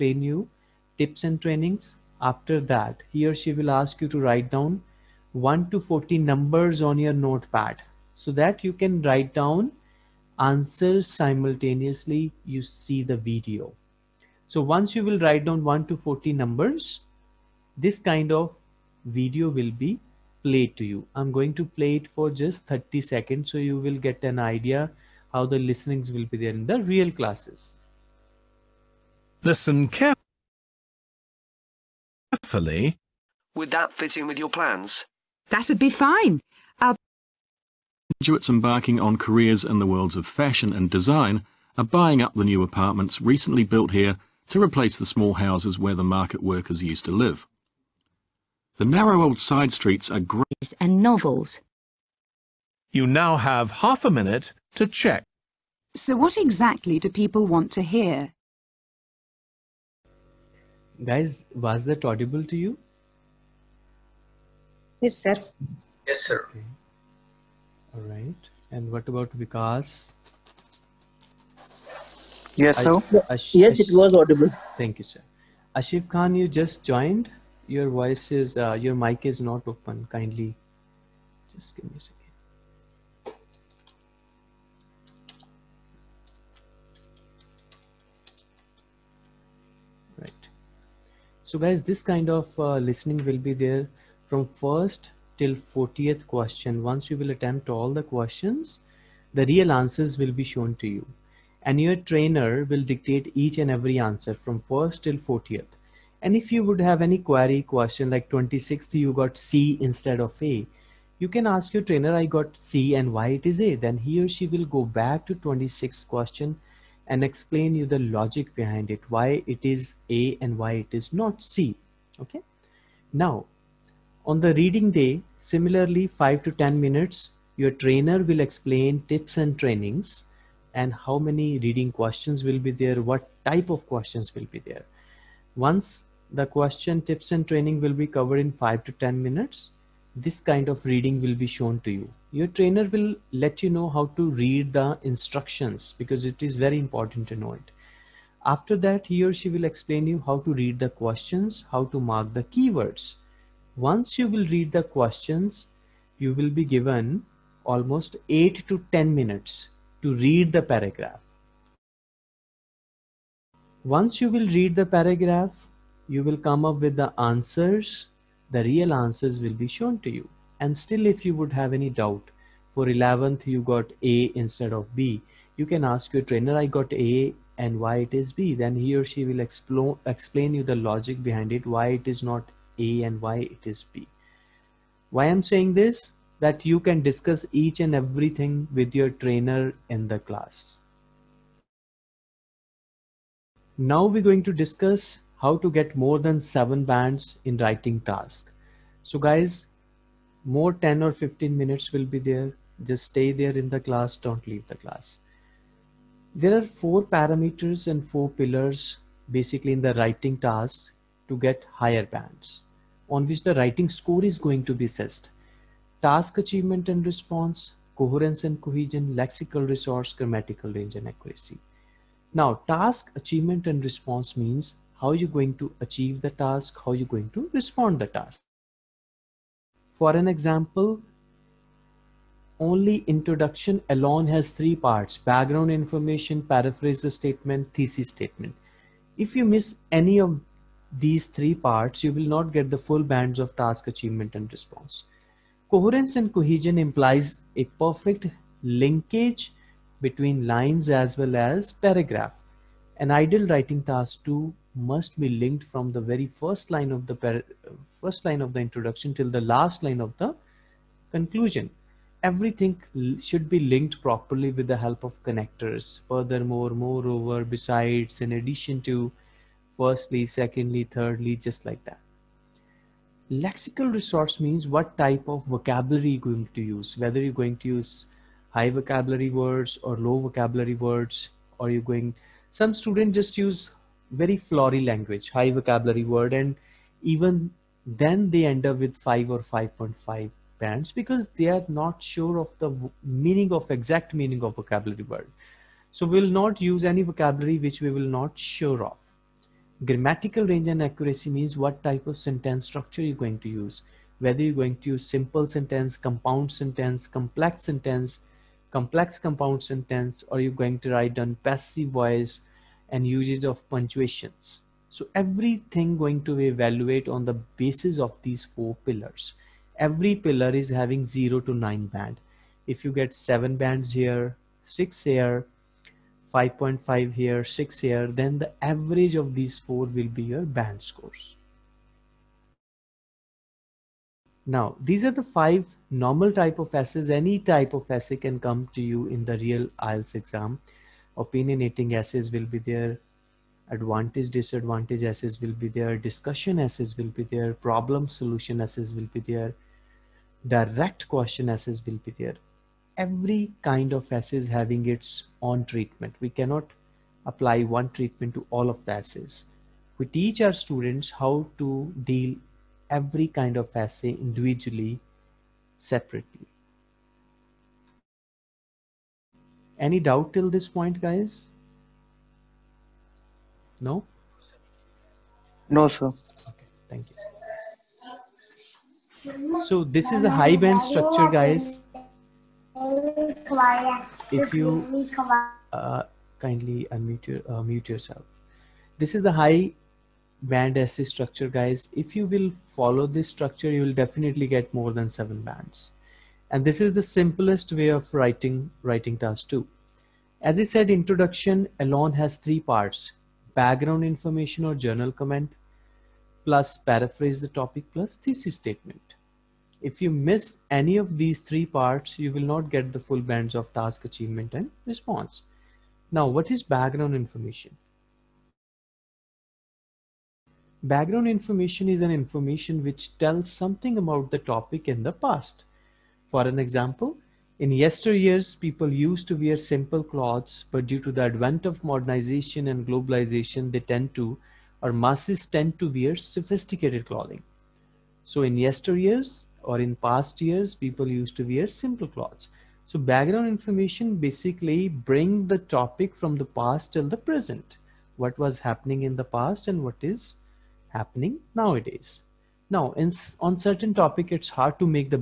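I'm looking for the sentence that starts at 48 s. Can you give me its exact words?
The narrow old side streets are great and novels.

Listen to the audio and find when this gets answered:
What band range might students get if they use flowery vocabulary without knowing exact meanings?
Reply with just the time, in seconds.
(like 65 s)
288 s.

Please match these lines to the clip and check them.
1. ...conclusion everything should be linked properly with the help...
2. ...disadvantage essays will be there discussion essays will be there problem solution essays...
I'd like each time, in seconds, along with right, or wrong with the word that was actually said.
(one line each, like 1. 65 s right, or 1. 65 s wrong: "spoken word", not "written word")
1. 261 s right
2. 344 s right.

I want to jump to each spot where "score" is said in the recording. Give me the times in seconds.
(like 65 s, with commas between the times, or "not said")
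213 s, 330 s.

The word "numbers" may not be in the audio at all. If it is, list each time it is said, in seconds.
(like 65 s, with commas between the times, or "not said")
6 s, 16 s.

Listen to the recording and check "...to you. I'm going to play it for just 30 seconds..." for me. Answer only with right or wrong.
right.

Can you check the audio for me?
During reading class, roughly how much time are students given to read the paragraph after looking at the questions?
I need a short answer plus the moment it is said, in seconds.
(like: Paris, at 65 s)
8 to 10 minutes, at 158 s.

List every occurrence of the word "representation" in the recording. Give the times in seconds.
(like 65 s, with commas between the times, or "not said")
not said.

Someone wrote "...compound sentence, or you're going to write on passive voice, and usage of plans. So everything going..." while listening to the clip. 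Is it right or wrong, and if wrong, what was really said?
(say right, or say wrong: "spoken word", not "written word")
wrong: "punctuations", not "plans".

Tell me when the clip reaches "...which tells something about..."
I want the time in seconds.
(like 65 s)
422 s.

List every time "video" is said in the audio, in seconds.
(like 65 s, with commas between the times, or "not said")
13 s, 19 s.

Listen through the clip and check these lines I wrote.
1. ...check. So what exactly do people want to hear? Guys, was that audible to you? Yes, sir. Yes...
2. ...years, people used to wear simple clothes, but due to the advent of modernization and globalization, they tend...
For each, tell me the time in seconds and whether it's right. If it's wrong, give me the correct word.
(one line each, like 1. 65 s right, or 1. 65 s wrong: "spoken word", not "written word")
1. 54 s right
2. 427 s wrong: "yesteryears", not "years".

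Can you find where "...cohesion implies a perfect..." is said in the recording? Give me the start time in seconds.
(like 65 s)
246 s.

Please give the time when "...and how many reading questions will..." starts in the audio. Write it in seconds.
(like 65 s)
130 s.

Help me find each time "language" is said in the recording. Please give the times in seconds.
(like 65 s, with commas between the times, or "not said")
284 s.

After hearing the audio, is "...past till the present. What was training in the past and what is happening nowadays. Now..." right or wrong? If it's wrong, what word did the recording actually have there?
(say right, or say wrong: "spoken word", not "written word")
wrong: "happening", not "training".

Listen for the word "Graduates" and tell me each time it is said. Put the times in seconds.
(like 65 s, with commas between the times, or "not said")
38 s.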